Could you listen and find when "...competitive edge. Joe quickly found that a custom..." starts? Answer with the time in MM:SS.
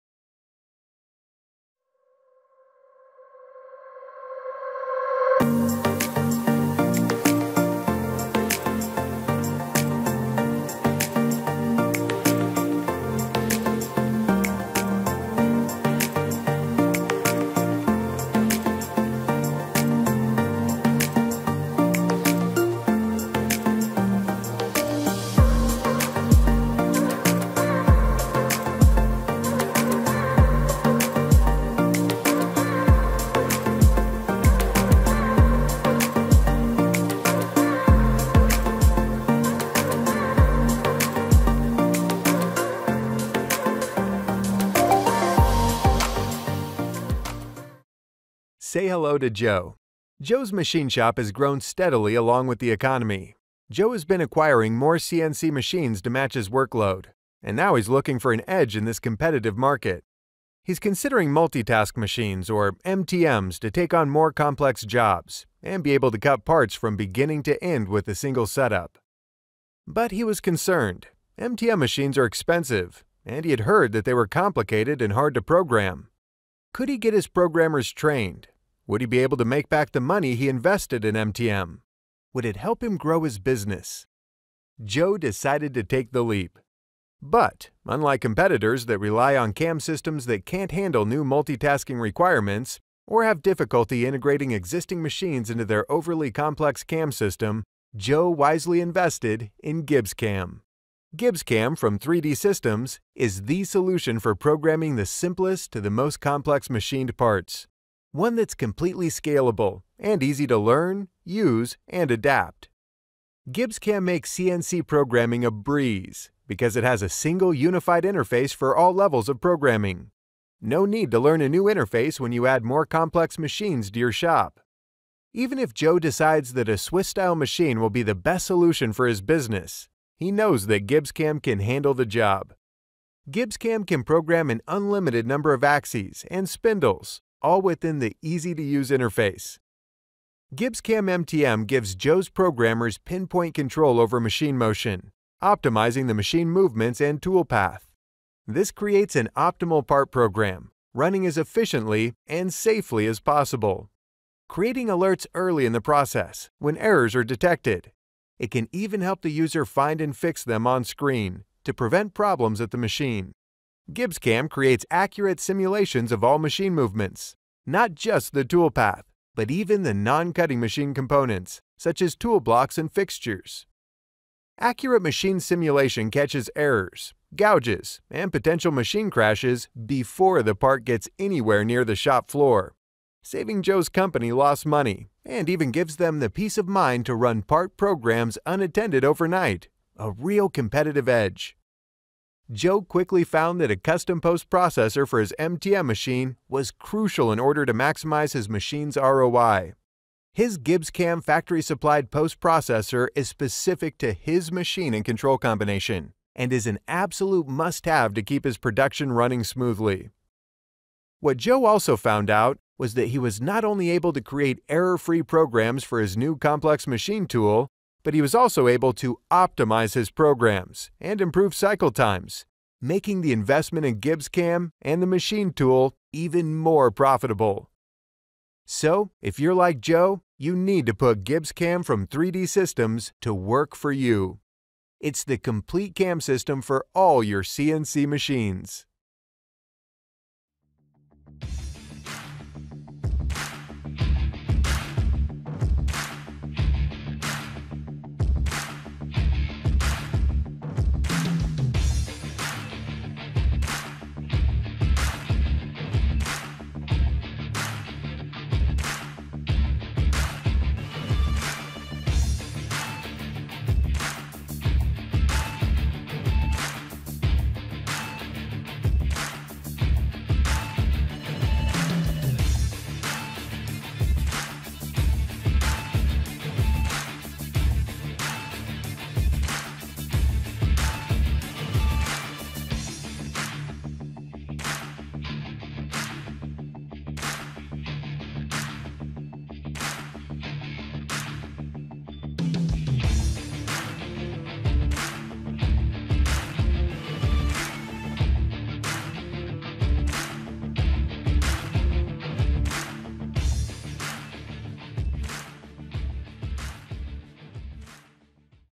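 03:10.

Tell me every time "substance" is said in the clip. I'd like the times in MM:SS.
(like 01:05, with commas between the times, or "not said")
not said.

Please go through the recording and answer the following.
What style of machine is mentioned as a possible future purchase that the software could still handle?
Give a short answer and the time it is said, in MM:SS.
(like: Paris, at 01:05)
Swiss-style, at 02:06.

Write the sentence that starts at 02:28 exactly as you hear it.
This creates an optimal part program, running as efficiently and safely as possible.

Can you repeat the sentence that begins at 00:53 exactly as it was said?
Joe has been acquiring more CNC machines to match his workload, and now he's looking for an edge in this competitive market.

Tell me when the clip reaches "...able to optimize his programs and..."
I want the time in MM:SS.
03:38.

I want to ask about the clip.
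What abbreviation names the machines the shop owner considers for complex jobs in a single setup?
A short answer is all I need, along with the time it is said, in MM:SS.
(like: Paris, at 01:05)
MTMs, at 01:02.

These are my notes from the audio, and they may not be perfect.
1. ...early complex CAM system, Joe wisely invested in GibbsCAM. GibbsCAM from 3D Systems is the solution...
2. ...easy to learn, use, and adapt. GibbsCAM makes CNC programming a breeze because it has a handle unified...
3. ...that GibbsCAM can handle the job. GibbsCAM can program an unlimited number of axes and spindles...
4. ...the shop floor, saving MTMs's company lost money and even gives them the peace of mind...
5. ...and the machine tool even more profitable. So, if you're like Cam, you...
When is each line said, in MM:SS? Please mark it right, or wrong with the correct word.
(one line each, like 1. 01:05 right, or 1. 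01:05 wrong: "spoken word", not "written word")
1. 01:35 wrong: "overly", not "early"
2. 01:50 wrong: "single", not "handle"
3. 02:10 right
4. 03:01 wrong: "Joe", not "MTMs"
5. 03:44 wrong: "Joe", not "Cam".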